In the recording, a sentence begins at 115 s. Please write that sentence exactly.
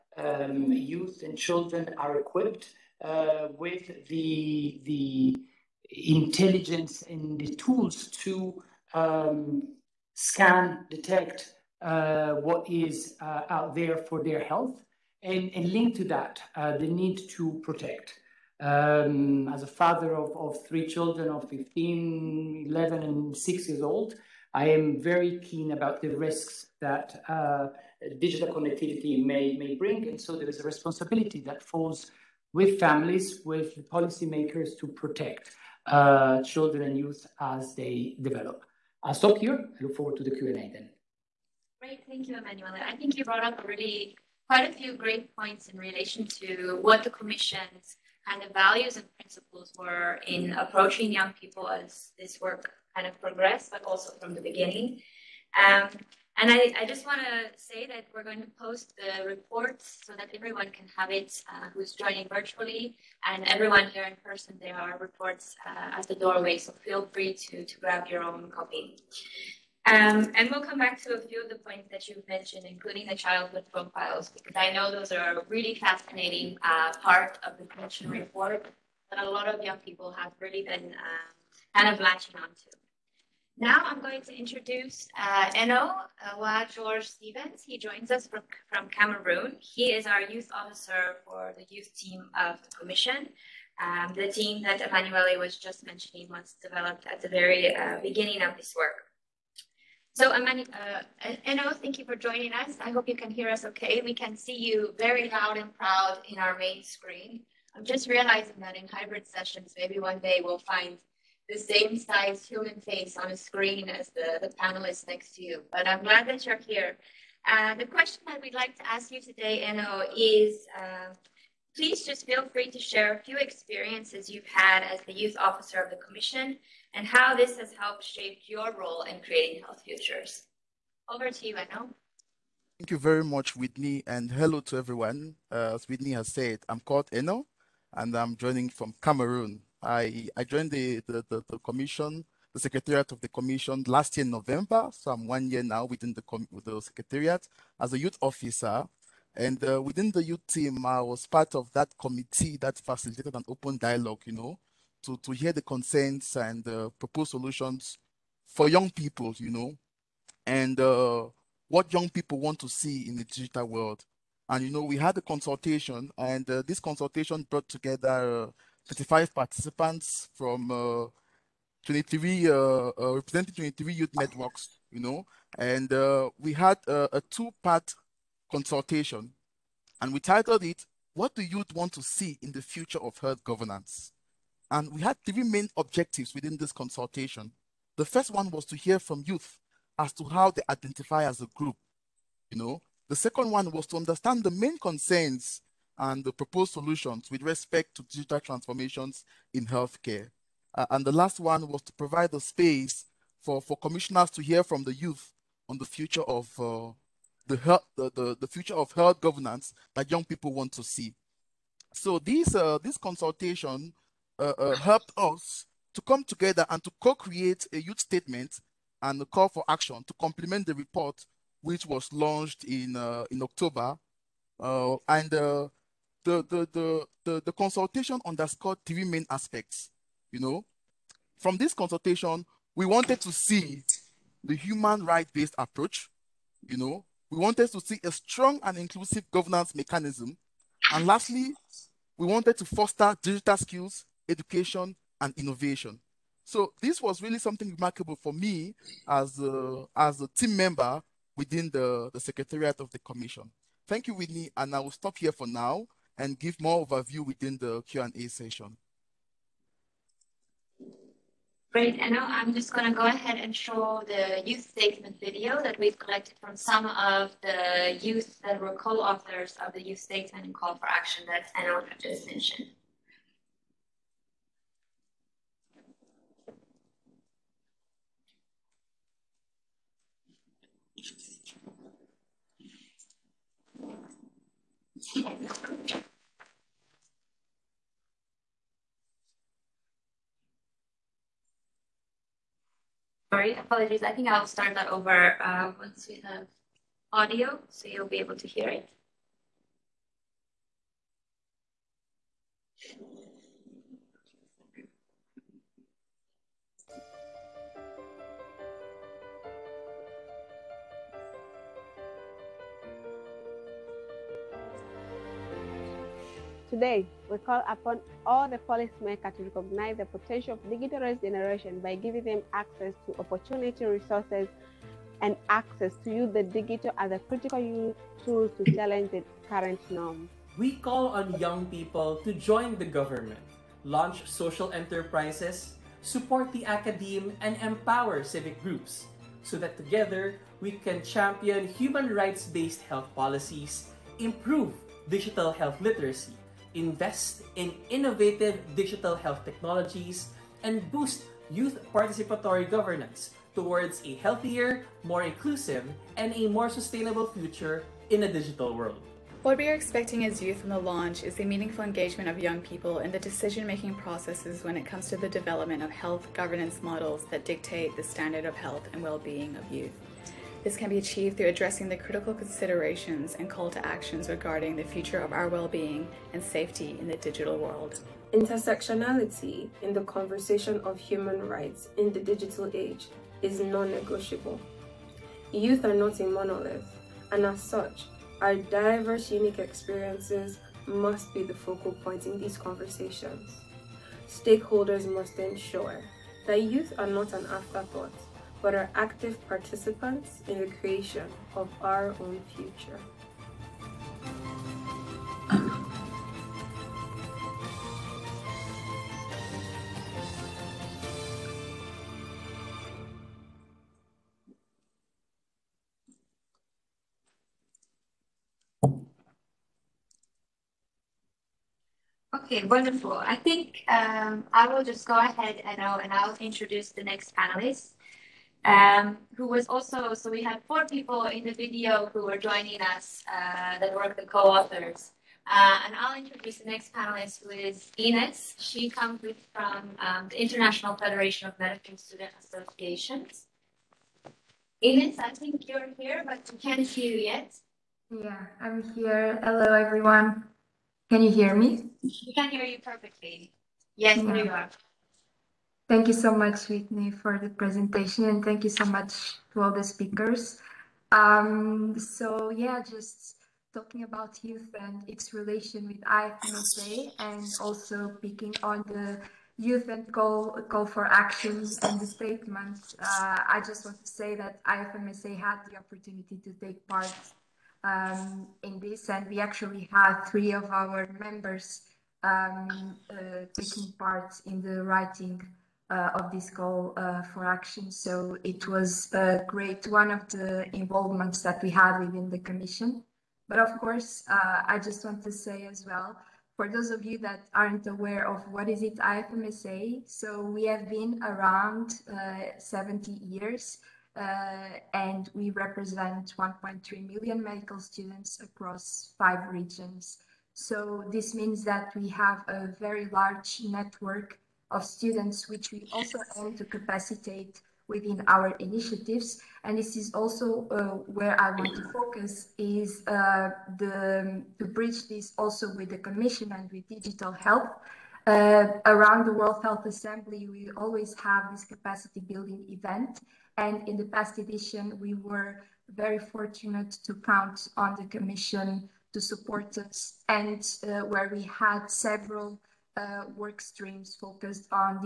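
But I'm glad that you're here.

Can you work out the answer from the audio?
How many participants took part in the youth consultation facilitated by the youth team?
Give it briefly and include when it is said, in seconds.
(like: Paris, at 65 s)
35, at 168 s.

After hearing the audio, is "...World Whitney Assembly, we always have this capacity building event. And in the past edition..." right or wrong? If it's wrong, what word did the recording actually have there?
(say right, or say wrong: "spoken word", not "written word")
wrong: "Health", not "Whitney".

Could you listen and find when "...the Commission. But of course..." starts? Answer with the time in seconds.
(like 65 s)
492 s.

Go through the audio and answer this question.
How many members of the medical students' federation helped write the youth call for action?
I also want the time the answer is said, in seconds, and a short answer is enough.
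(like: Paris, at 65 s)
3, at 480 s.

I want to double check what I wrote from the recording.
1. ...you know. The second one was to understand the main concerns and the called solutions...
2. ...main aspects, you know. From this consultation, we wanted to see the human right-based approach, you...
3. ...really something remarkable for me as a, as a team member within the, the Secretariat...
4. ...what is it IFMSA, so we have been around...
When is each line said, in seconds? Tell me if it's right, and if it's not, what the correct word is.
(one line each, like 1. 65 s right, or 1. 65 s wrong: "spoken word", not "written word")
1. 192 s wrong: "proposed", not "called"
2. 229 s right
3. 247 s right
4. 498 s right.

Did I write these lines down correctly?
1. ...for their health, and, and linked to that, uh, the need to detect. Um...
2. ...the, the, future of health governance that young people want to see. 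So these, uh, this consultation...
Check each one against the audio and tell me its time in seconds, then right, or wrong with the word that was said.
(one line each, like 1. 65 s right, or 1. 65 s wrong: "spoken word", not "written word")
1. 13 s wrong: "protect", not "detect"
2. 208 s right.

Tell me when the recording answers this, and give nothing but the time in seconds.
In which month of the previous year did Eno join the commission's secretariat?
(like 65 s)
144 s.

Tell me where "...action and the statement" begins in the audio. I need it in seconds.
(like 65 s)
471 s.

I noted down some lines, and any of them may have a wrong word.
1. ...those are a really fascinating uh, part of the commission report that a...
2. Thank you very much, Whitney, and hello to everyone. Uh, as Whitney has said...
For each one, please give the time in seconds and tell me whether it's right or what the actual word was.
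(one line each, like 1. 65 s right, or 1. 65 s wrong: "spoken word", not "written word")
1. 74 s right
2. 132 s right.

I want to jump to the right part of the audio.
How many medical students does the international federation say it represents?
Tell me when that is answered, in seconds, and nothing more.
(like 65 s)
506 s.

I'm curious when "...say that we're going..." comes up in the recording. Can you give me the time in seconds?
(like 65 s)
57 s.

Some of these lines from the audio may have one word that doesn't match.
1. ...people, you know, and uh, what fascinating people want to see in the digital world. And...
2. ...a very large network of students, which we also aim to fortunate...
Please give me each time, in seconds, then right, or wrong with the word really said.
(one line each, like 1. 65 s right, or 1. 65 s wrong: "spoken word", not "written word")
1. 158 s wrong: "young", not "fascinating"
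2. 512 s wrong: "capacitate", not "fortunate".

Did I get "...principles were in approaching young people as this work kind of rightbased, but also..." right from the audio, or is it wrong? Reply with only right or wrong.
wrong.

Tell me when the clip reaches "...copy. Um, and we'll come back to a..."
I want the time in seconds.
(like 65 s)
68 s.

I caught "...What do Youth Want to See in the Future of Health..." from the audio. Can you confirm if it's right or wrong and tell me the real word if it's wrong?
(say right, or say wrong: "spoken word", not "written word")
right.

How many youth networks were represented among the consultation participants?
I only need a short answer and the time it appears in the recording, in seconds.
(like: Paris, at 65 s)
23, at 173 s.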